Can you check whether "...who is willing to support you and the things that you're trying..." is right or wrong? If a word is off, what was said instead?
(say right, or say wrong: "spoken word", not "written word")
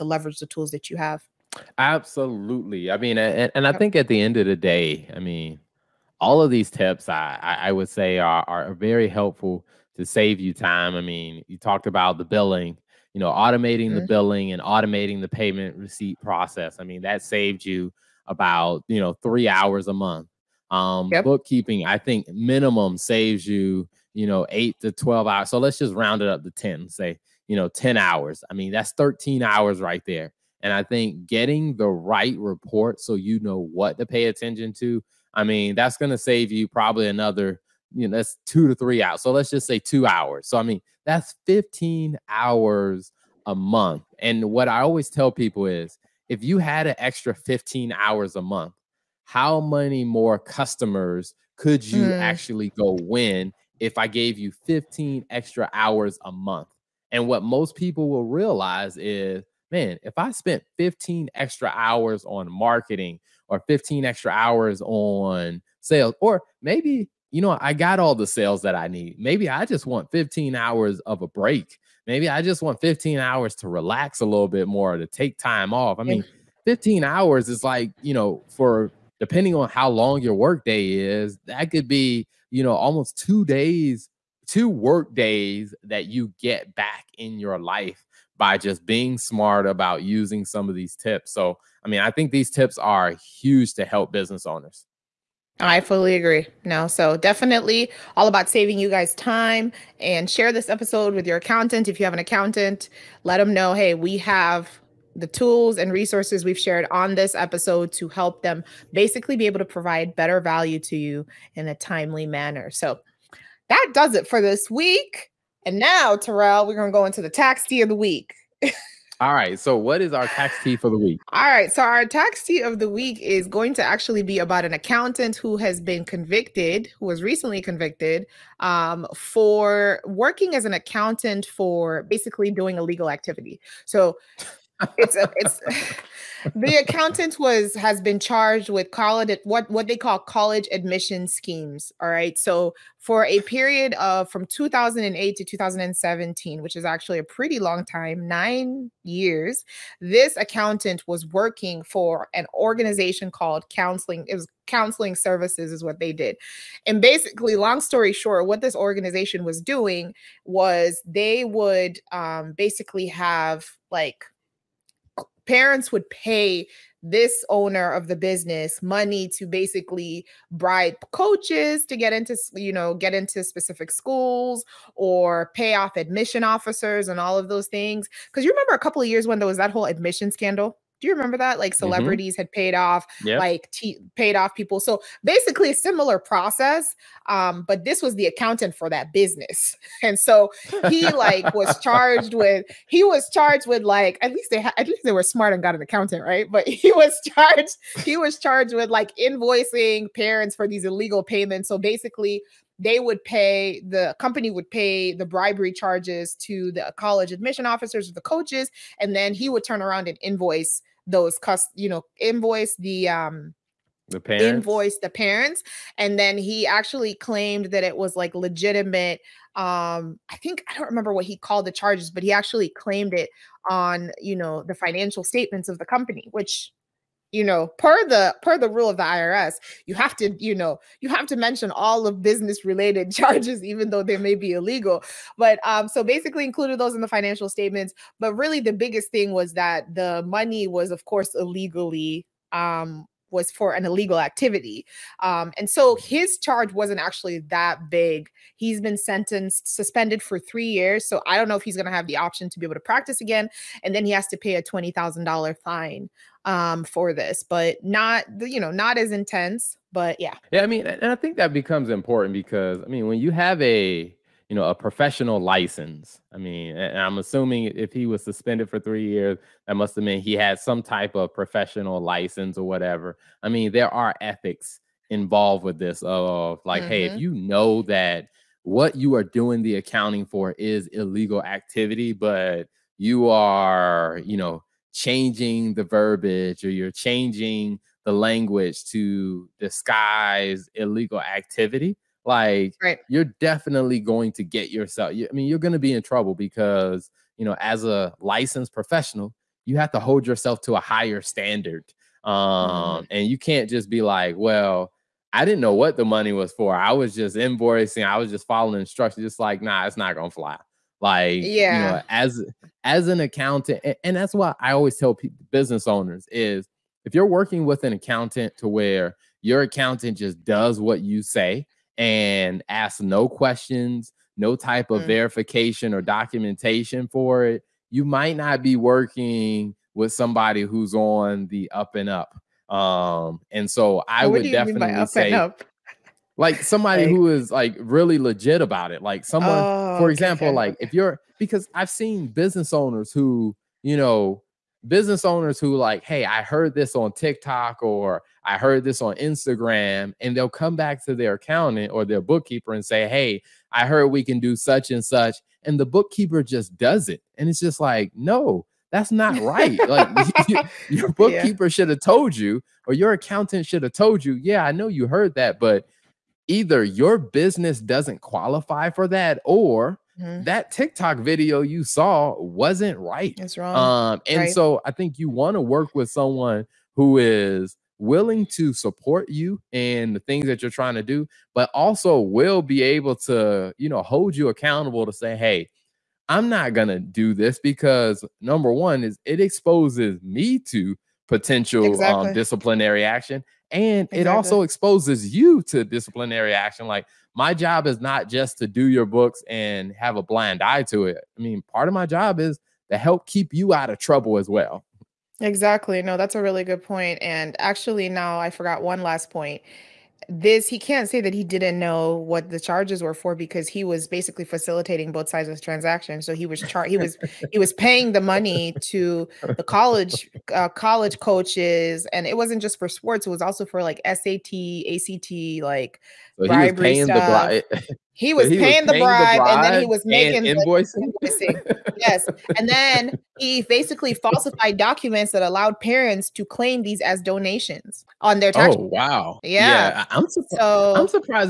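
right.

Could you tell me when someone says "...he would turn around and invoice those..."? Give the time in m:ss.
3:29.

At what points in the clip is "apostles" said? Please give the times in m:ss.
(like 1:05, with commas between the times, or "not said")
not said.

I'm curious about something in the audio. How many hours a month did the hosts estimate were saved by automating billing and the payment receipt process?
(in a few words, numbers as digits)
3 hours.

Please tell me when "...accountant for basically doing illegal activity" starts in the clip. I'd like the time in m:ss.
2:10.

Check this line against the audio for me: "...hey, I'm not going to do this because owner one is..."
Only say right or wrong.
wrong.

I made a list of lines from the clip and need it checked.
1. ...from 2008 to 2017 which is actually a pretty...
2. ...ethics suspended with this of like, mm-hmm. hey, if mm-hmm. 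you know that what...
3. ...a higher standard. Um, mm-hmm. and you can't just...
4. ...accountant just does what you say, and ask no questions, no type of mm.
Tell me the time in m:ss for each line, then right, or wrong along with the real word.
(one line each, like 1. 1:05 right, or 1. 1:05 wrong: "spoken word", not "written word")
1. 2:24 right
2. 4:34 wrong: "involved", not "suspended"
3. 5:00 right
4. 5:19 right.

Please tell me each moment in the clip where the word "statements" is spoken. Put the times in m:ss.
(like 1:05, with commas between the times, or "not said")
3:45, 3:57.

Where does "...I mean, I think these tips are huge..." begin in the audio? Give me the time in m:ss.
1:31.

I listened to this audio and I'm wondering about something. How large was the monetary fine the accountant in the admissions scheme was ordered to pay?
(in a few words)
$20,000.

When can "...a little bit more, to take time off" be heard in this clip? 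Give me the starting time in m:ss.
1:14.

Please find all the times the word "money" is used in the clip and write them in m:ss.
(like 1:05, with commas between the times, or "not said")
2:48, 4:00, 5:06, 6:58.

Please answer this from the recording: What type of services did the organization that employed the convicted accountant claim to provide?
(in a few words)
Counseling services.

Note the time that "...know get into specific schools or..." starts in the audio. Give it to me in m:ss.
2:52.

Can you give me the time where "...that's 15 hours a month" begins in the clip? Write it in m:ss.
0:41.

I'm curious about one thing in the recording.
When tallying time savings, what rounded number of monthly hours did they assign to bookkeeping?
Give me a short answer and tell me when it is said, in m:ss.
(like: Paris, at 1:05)
10, at 0:25.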